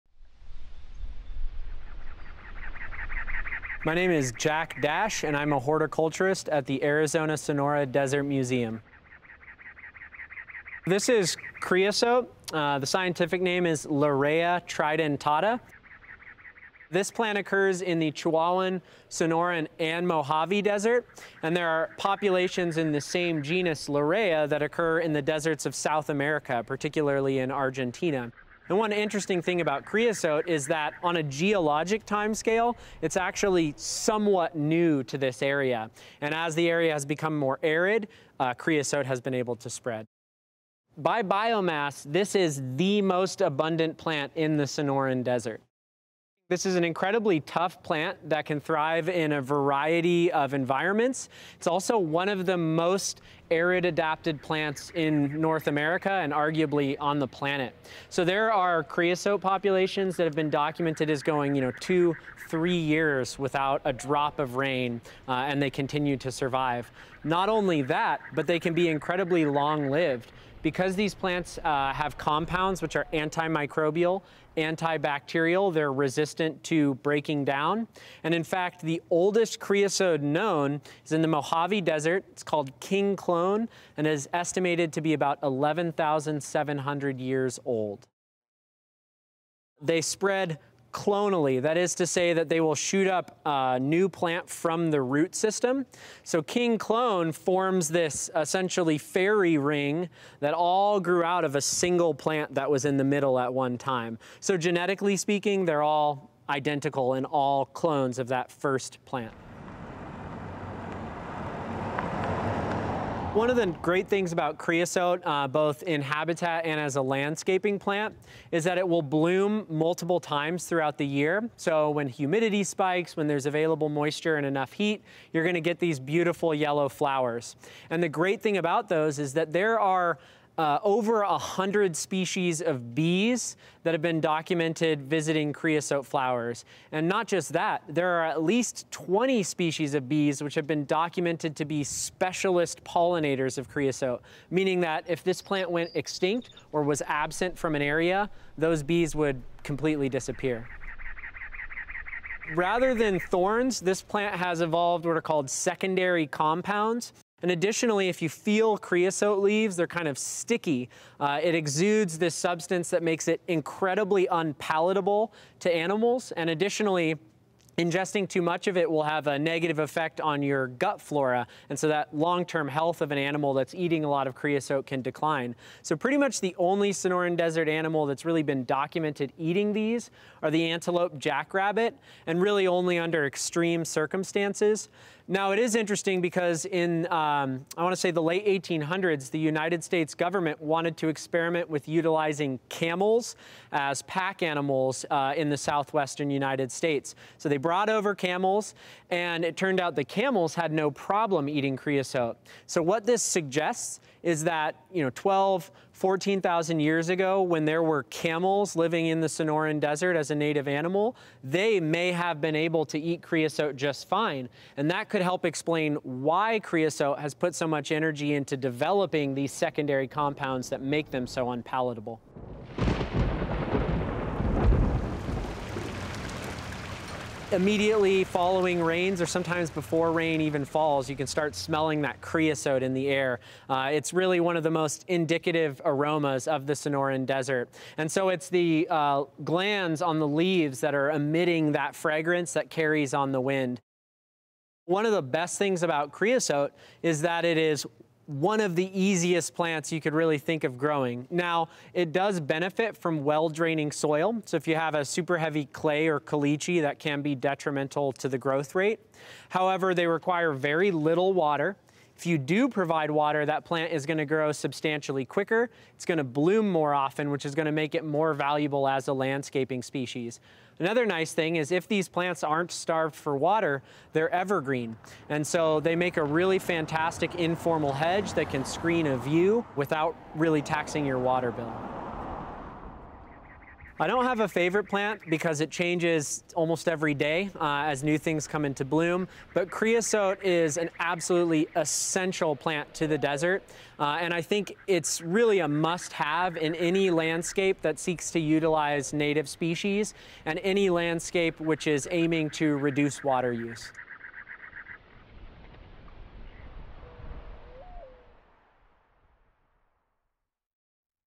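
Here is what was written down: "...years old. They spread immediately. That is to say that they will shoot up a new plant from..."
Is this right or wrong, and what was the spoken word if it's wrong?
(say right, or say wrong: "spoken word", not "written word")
wrong: "clonally", not "immediately".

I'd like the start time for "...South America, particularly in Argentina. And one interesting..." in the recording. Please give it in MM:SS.
00:25.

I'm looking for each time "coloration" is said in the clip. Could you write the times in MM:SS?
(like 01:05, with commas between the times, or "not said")
not said.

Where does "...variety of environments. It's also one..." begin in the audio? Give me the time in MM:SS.
00:49.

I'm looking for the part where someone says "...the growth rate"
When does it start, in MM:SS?
04:18.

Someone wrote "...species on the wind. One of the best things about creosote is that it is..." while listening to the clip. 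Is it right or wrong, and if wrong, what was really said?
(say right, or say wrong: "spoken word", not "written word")
wrong: "carries", not "species".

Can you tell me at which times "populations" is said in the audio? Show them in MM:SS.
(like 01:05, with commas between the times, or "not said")
00:21, 00:59.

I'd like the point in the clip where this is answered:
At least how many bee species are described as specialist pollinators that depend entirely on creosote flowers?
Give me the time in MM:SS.
02:18.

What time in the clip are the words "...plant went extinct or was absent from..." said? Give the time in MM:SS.
02:25.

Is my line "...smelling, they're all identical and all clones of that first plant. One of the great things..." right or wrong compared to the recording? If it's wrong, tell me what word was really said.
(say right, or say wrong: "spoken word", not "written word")
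wrong: "speaking", not "smelling".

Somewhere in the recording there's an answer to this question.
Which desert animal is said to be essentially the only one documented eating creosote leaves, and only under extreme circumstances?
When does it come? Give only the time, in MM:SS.
03:00.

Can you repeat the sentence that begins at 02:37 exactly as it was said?
And additionally, if you feel creosote leaves, they're kind of sticky.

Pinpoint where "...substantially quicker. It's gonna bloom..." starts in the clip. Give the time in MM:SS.
04:24.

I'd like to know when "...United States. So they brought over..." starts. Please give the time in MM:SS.
03:16.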